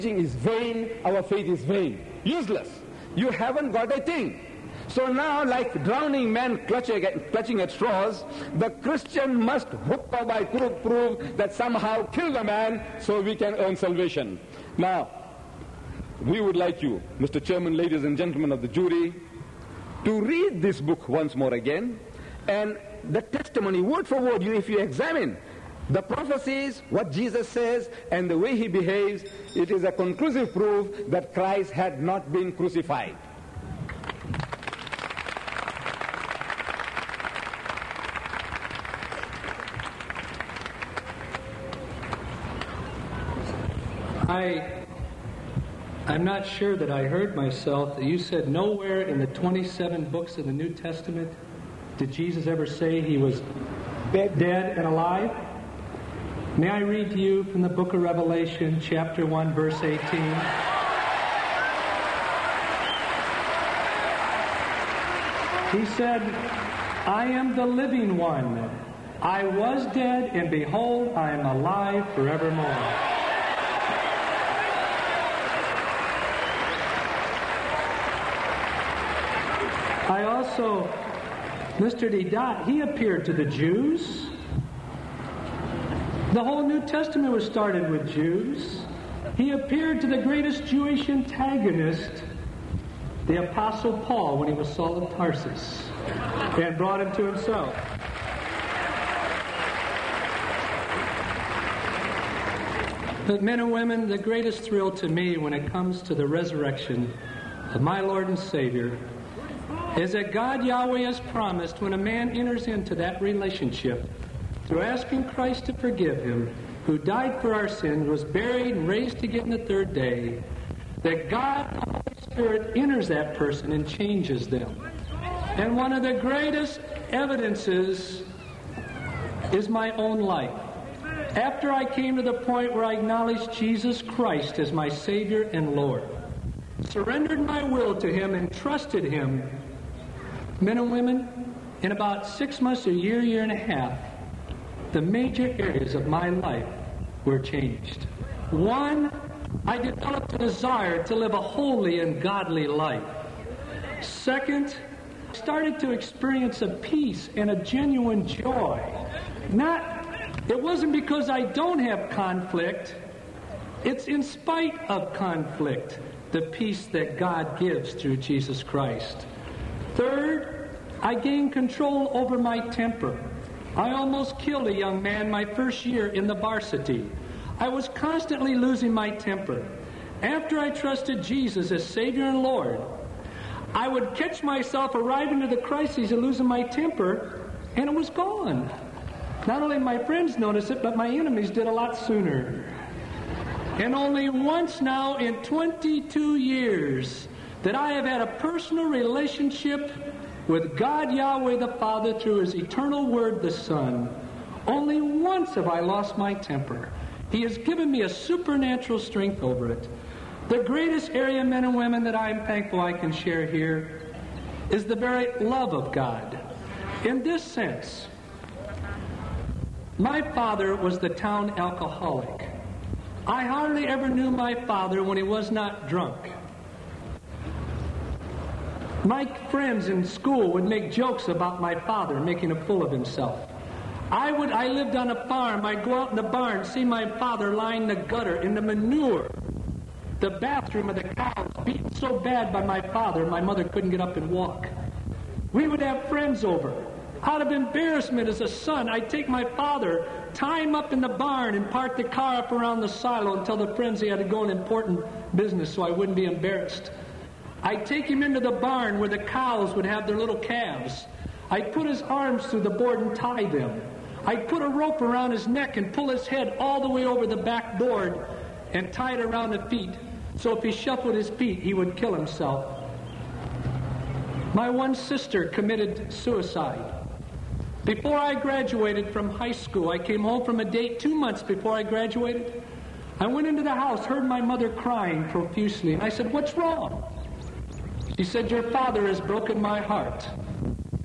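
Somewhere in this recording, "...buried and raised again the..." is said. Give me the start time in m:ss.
1:58.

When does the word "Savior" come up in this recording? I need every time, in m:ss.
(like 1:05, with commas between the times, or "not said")
1:48, 2:14, 3:01.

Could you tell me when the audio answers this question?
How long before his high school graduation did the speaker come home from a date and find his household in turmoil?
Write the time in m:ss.
4:40.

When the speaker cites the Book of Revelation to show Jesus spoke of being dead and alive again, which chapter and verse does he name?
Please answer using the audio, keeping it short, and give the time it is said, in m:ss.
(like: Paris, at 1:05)
Chapter 1, verse 18, at 0:58.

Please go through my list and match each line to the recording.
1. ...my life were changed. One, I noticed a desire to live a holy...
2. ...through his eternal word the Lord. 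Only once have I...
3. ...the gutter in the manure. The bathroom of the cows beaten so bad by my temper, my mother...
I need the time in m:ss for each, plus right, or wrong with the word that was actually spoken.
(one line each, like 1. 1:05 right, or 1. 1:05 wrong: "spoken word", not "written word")
1. 2:26 wrong: "developed", not "noticed"
2. 3:22 wrong: "Son", not "Lord"
3. 3:57 wrong: "father", not "temper".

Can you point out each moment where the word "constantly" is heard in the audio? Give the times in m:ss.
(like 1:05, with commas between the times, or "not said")
2:57.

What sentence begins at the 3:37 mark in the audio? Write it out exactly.
In this sense, my father was the town alcoholic.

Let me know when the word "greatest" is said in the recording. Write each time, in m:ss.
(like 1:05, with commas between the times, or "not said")
1:30, 1:44, 2:06, 3:30.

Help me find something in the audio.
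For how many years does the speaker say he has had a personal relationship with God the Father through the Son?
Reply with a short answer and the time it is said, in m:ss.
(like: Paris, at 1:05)
22 years, at 3:15.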